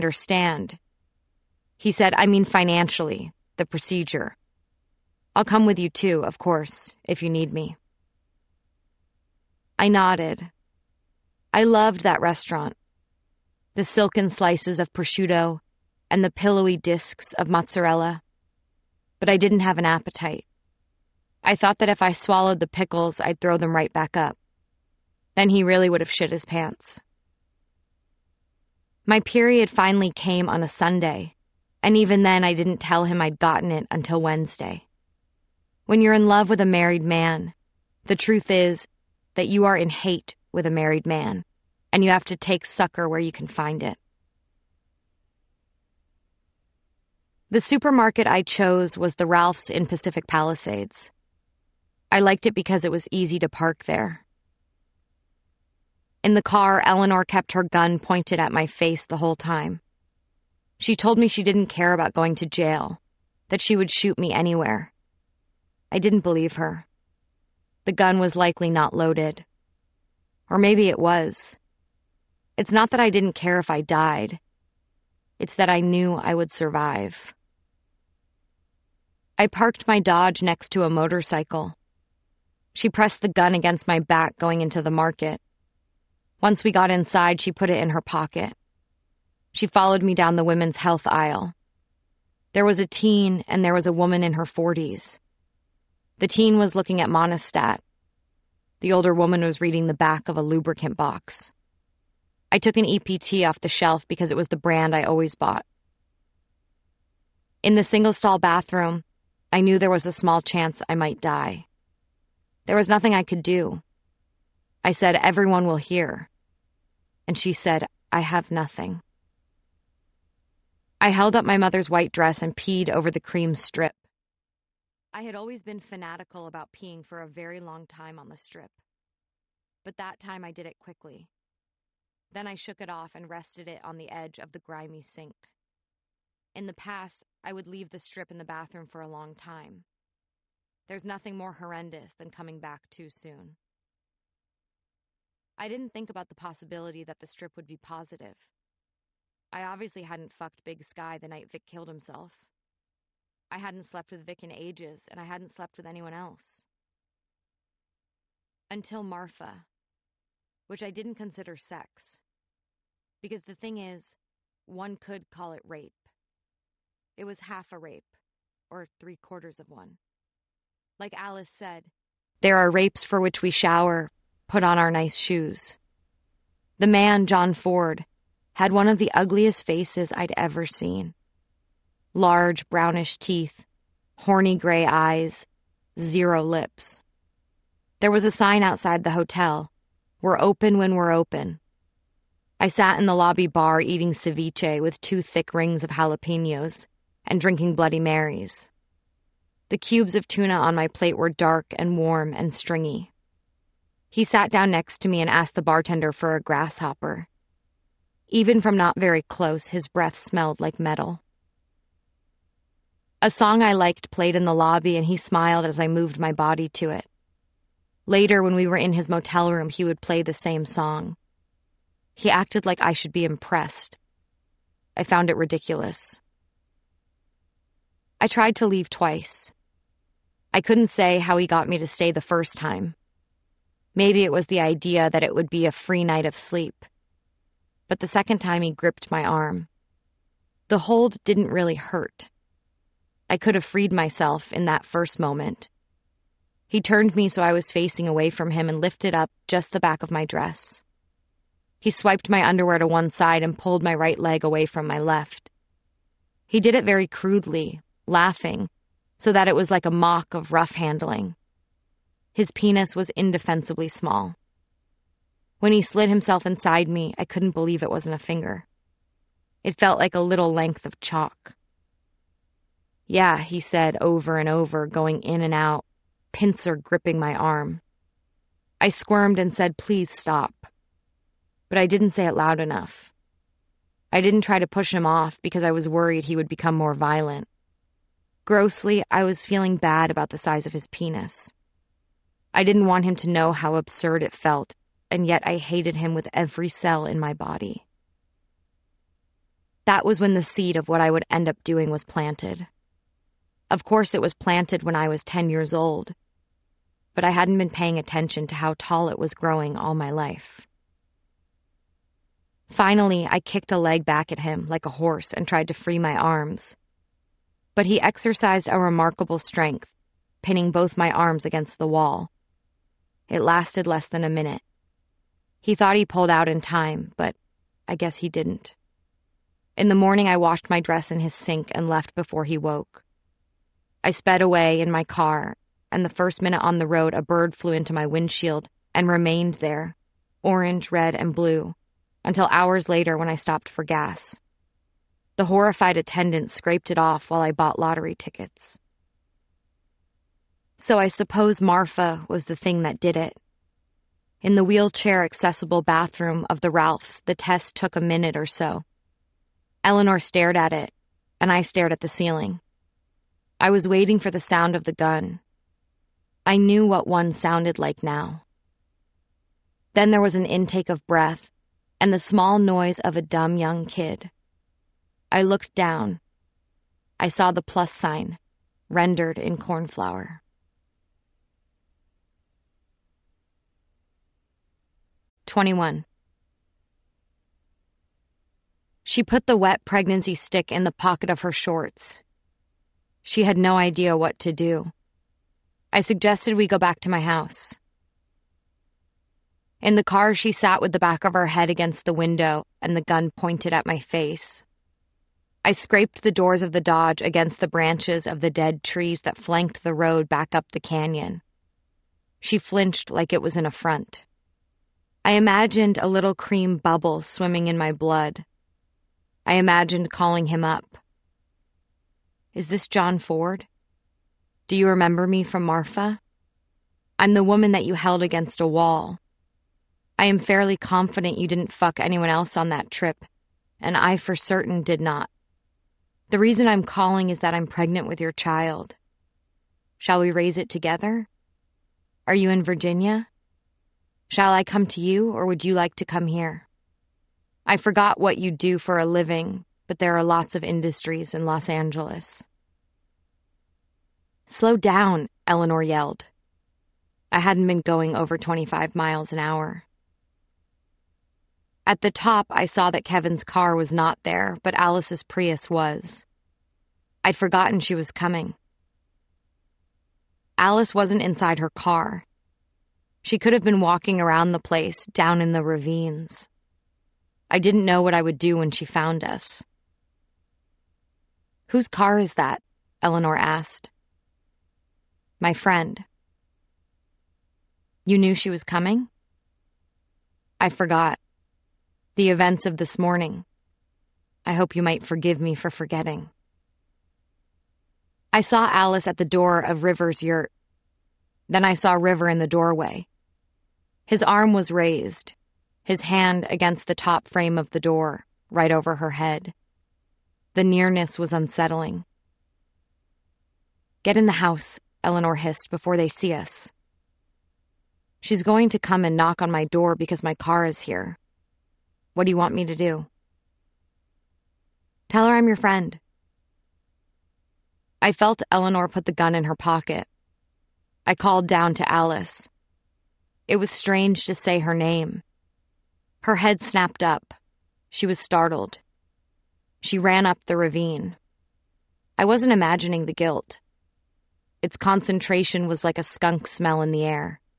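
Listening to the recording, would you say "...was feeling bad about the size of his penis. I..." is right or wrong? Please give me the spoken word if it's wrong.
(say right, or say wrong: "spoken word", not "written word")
right.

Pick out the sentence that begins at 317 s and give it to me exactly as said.
But he exercised a remarkable strength, pinning both my arms against the wall.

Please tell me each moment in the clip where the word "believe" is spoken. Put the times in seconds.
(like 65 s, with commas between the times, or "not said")
66 s, 267 s.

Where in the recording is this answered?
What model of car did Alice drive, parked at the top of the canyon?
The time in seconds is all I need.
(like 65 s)
465 s.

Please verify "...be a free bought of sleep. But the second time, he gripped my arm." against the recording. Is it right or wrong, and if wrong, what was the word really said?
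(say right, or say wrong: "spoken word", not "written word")
wrong: "night", not "bought".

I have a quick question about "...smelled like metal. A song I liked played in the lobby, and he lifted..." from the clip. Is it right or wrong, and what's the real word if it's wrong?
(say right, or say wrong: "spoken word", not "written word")
wrong: "smiled", not "lifted".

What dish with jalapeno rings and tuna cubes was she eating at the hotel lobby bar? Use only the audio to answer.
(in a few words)
Ceviche.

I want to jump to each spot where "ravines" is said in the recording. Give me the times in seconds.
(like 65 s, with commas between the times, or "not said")
475 s, 540 s.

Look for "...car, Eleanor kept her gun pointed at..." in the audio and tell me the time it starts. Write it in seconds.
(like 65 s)
56 s.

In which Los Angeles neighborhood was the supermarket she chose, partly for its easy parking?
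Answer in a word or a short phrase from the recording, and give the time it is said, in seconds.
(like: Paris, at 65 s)
Pacific Palisades, at 49 s.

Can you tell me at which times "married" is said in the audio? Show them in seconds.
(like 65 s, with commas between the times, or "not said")
36 s, 40 s.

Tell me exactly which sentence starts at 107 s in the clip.
In the single stall bathroom, I knew there was a small chance I might die.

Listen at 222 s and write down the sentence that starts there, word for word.
He acted like I should be impressed.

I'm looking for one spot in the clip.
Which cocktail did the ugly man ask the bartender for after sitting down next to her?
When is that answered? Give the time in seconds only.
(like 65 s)
206 s.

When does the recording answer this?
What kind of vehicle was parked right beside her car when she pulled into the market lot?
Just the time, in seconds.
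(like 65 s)
80 s.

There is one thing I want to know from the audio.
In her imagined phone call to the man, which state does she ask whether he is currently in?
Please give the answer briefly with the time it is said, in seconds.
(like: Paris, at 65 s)
Virginia, at 442 s.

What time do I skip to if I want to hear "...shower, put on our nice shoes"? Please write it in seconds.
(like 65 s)
173 s.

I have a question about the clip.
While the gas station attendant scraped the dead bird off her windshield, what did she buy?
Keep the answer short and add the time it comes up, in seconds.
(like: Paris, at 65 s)
Lottery tickets, at 347 s.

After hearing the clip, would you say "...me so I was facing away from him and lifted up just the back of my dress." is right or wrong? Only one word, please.
right.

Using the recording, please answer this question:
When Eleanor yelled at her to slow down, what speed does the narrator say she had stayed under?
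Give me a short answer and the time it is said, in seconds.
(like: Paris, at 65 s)
25 miles an hour, at 458 s.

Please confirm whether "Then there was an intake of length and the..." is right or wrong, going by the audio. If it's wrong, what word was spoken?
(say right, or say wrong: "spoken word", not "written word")
wrong: "breath", not "length".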